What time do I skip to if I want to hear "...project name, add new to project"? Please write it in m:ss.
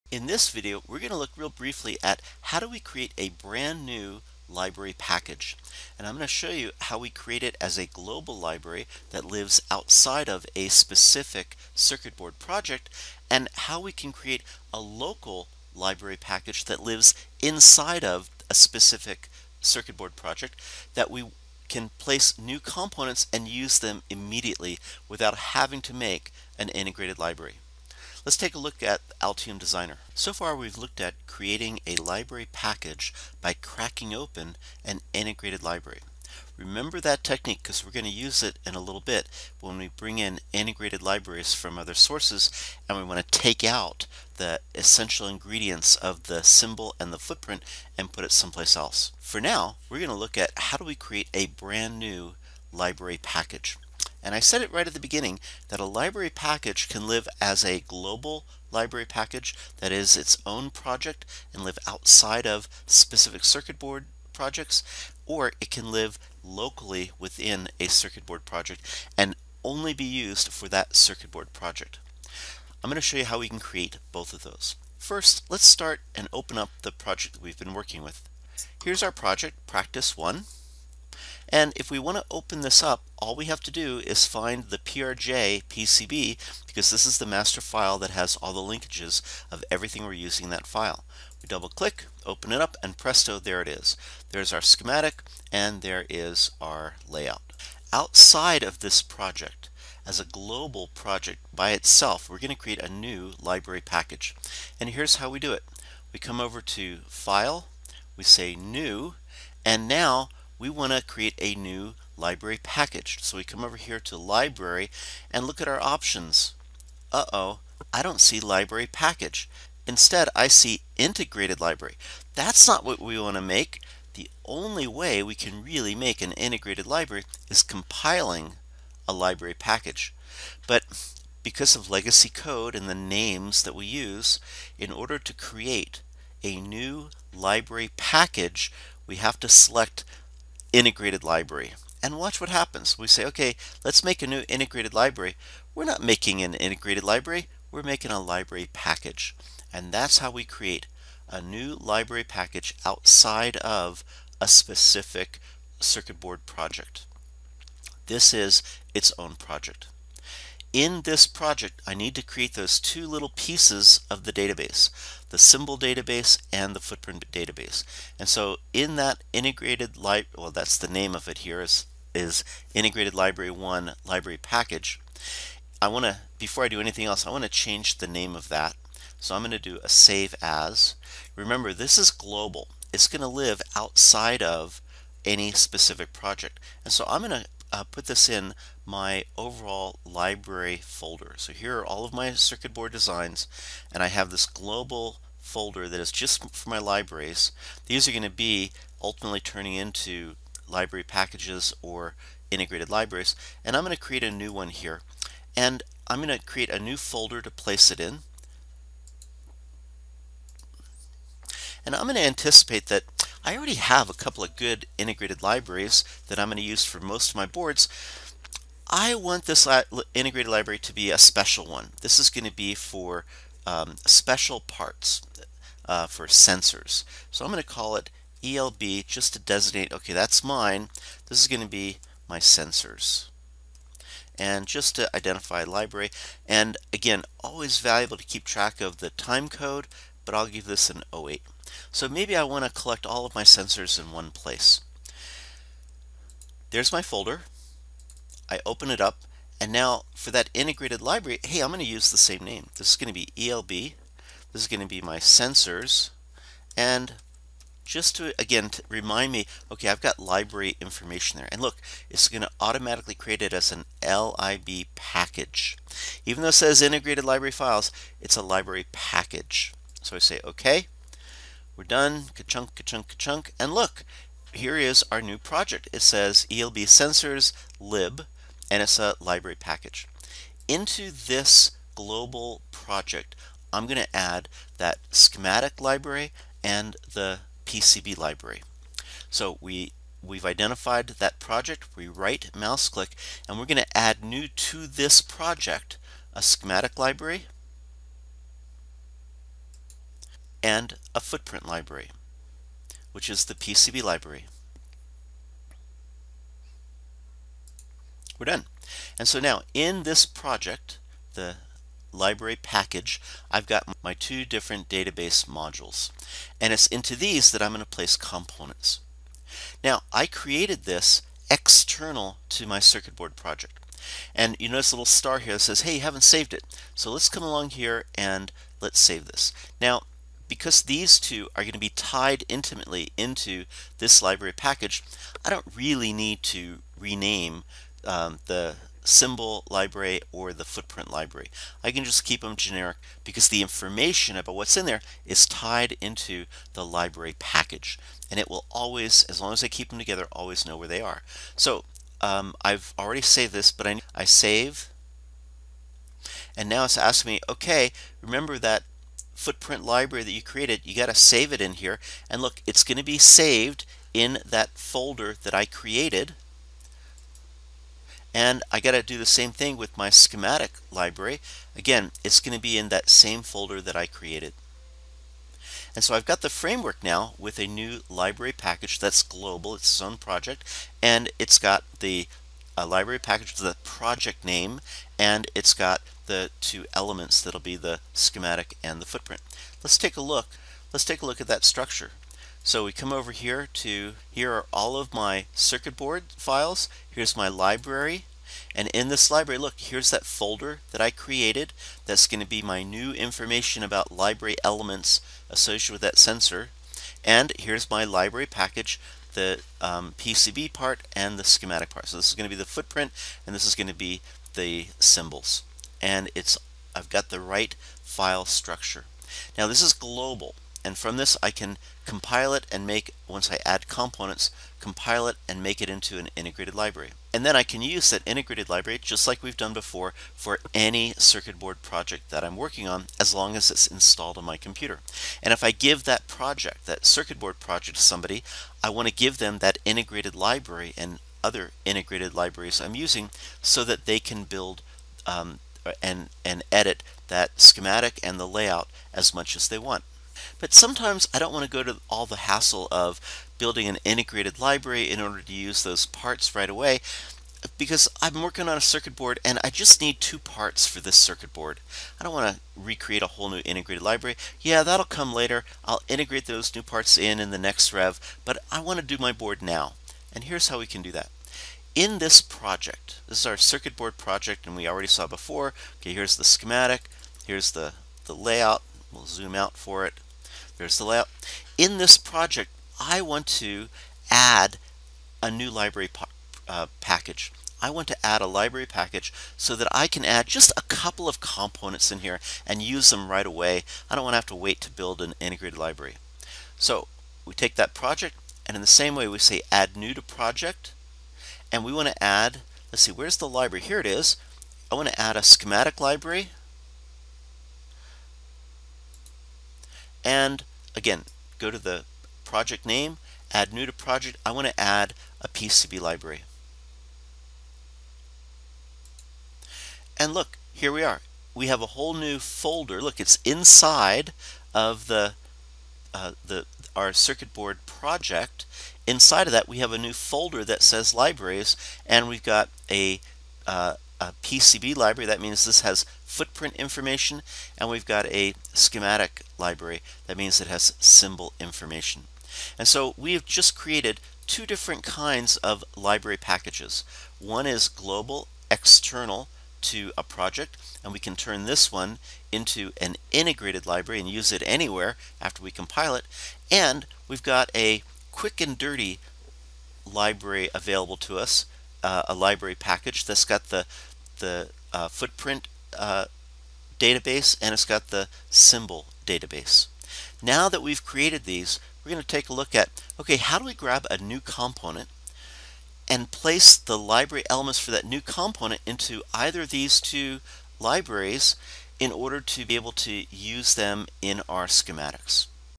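8:32.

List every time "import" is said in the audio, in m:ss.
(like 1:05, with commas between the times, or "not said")
not said.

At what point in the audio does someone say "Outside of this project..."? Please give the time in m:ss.
1:37.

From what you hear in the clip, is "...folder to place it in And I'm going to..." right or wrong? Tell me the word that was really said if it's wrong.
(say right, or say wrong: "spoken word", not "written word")
right.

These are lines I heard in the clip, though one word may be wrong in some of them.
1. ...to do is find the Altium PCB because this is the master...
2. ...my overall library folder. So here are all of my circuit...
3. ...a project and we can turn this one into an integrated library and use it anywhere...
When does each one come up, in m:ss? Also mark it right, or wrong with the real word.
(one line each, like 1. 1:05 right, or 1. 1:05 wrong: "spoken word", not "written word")
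1. 1:23 wrong: "PRJ", not "Altium"
2. 3:08 right
3. 9:10 right.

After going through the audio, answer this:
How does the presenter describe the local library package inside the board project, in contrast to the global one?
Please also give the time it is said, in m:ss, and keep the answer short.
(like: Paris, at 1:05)
quick and dirty, at 9:18.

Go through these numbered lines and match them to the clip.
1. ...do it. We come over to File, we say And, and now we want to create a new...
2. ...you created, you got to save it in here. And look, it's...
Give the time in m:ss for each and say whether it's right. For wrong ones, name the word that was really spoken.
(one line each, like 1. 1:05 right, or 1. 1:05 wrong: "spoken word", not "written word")
1. 1:45 wrong: "New", not "And"
2. 6:00 right.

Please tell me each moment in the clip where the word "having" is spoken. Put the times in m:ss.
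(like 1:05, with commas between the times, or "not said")
0:25.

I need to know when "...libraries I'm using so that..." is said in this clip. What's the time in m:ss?
7:22.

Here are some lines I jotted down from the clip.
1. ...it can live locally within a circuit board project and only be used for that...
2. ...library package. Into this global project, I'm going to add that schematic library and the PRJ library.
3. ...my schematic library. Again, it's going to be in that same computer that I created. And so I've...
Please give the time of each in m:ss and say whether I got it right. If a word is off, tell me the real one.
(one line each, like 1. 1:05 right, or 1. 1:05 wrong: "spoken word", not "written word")
1. 1:05 right
2. 4:39 wrong: "PCB", not "PRJ"
3. 6:09 wrong: "folder", not "computer".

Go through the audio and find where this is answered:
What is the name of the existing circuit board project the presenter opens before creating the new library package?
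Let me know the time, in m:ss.
1:19.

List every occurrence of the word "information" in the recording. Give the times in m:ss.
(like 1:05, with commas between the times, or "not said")
4:20, 5:43, 6:43, 8:56, 9:01.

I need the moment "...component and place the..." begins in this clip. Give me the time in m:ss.
9:34.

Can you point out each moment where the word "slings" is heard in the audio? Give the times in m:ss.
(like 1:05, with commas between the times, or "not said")
not said.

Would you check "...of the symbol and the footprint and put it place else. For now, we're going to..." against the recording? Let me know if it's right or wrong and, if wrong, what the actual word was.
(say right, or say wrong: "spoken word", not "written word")
wrong: "someplace", not "place".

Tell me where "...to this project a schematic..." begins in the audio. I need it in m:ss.
4:54.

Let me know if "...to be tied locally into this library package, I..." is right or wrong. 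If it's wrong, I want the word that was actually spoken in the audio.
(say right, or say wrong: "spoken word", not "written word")
wrong: "intimately", not "locally".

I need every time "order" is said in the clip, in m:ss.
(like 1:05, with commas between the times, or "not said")
2:14, 7:35, 9:42.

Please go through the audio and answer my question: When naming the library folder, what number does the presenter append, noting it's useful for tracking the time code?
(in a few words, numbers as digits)
08.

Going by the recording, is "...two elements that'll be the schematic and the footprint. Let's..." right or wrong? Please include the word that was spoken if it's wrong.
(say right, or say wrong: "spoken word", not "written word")
right.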